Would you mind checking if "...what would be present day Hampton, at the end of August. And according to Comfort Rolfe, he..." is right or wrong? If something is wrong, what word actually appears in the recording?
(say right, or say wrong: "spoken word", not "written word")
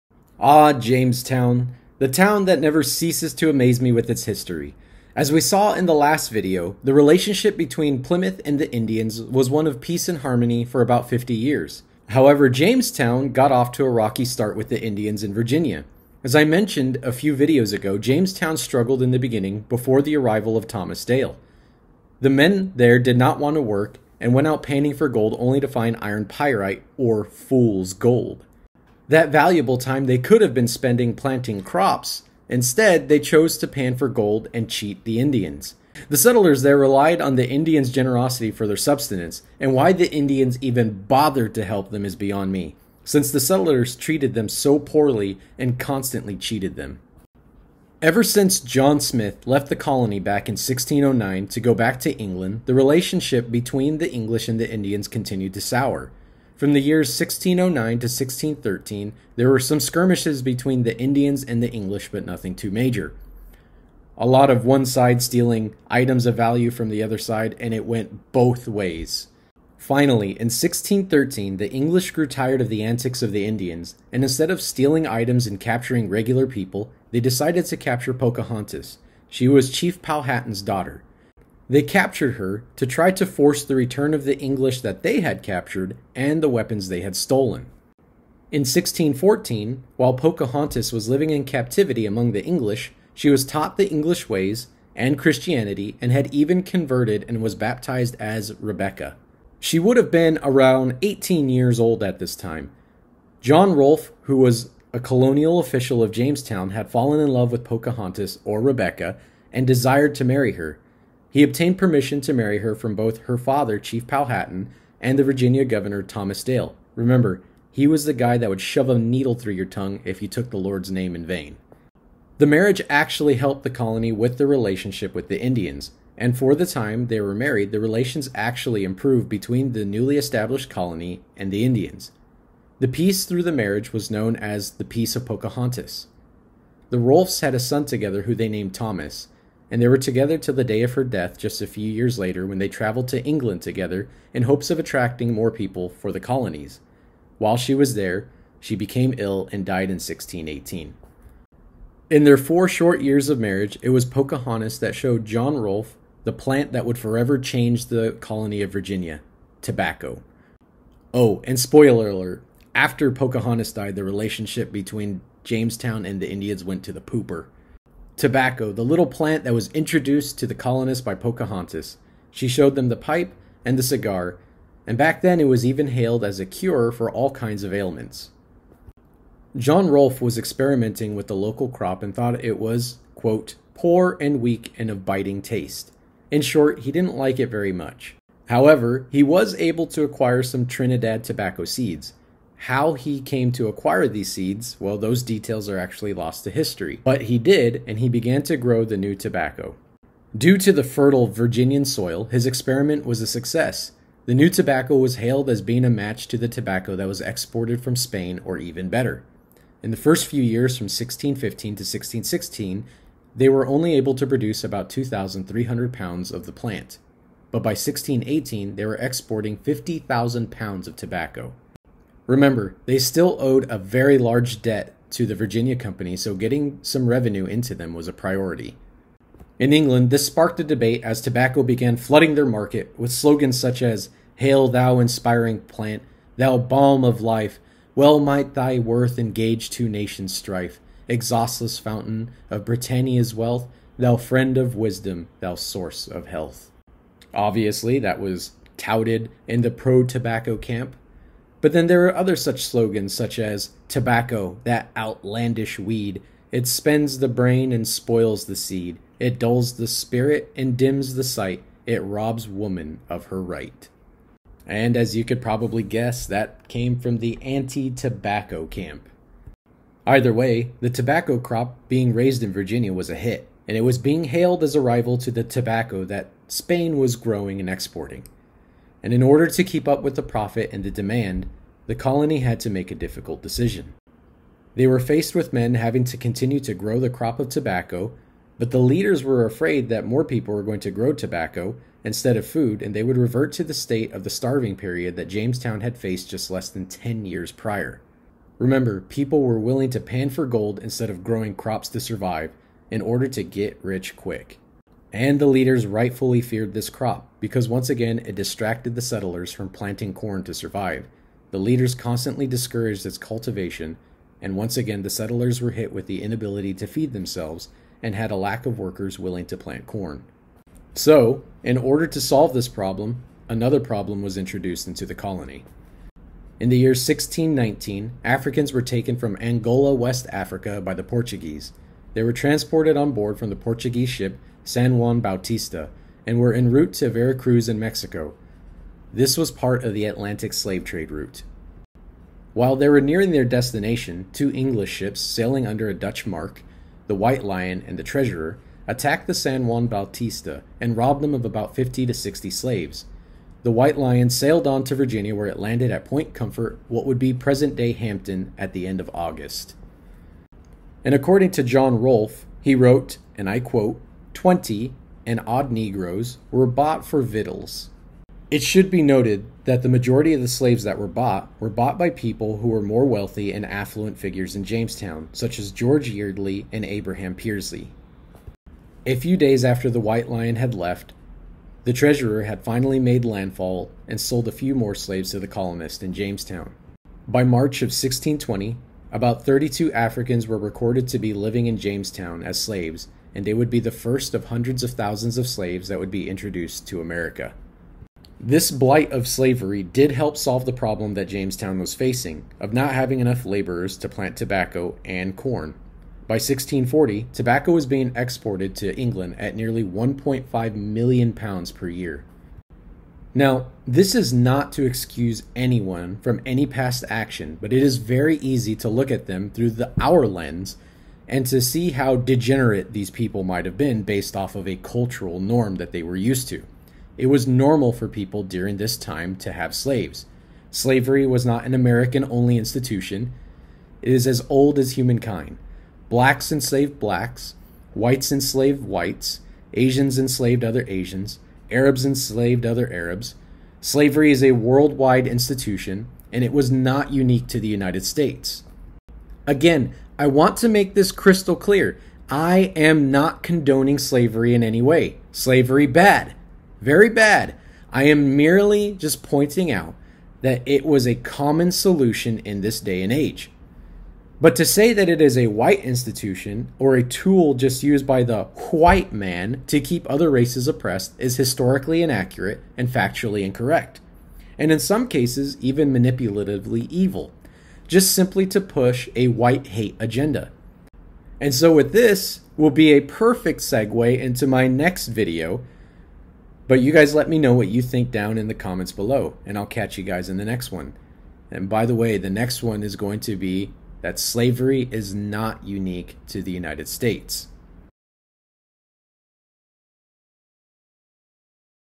wrong: "John", not "Comfort".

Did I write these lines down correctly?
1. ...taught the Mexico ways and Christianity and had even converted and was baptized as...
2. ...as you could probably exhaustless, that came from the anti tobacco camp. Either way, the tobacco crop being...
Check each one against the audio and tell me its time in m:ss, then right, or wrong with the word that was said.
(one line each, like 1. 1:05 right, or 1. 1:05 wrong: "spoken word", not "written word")
1. 1:33 wrong: "English", not "Mexico"
2. 4:24 wrong: "guess", not "exhaustless".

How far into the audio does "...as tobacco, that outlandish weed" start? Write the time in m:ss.
4:13.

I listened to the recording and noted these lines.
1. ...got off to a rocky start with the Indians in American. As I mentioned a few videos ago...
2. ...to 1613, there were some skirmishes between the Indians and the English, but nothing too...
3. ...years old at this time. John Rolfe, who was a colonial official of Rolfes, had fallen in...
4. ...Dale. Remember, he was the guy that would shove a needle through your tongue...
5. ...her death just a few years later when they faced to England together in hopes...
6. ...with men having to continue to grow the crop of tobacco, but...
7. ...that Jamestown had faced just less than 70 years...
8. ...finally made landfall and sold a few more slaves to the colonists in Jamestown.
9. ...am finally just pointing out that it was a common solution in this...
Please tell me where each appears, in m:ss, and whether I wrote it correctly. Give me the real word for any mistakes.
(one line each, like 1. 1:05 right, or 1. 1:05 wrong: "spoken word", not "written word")
1. 0:13 wrong: "Virginia", not "American"
2. 0:57 right
3. 1:41 wrong: "Jamestown", not "Rolfes"
4. 1:56 right
5. 2:20 wrong: "traveled", not "faced"
6. 4:45 right
7. 4:55 wrong: "10", not "70"
8. 6:22 right
9. 7:38 wrong: "merely", not "finally".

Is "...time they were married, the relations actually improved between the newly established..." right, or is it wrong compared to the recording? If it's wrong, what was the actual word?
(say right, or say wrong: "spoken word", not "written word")
right.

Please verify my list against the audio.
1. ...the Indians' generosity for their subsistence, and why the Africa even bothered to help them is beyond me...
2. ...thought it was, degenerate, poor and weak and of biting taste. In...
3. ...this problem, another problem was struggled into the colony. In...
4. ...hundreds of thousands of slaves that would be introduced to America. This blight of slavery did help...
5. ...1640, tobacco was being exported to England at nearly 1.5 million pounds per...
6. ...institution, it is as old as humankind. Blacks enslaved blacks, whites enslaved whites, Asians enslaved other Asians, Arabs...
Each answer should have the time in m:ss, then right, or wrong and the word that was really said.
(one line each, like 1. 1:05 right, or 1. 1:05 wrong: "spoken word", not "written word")
1. 0:37 wrong: "Indians", not "Africa"
2. 3:02 wrong: "quote", not "degenerate"
3. 5:22 wrong: "introduced", not "struggled"
4. 6:34 right
5. 6:46 right
6. 7:12 right.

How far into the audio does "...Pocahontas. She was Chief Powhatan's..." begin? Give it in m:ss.
1:18.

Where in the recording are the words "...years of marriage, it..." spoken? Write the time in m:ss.
2:33.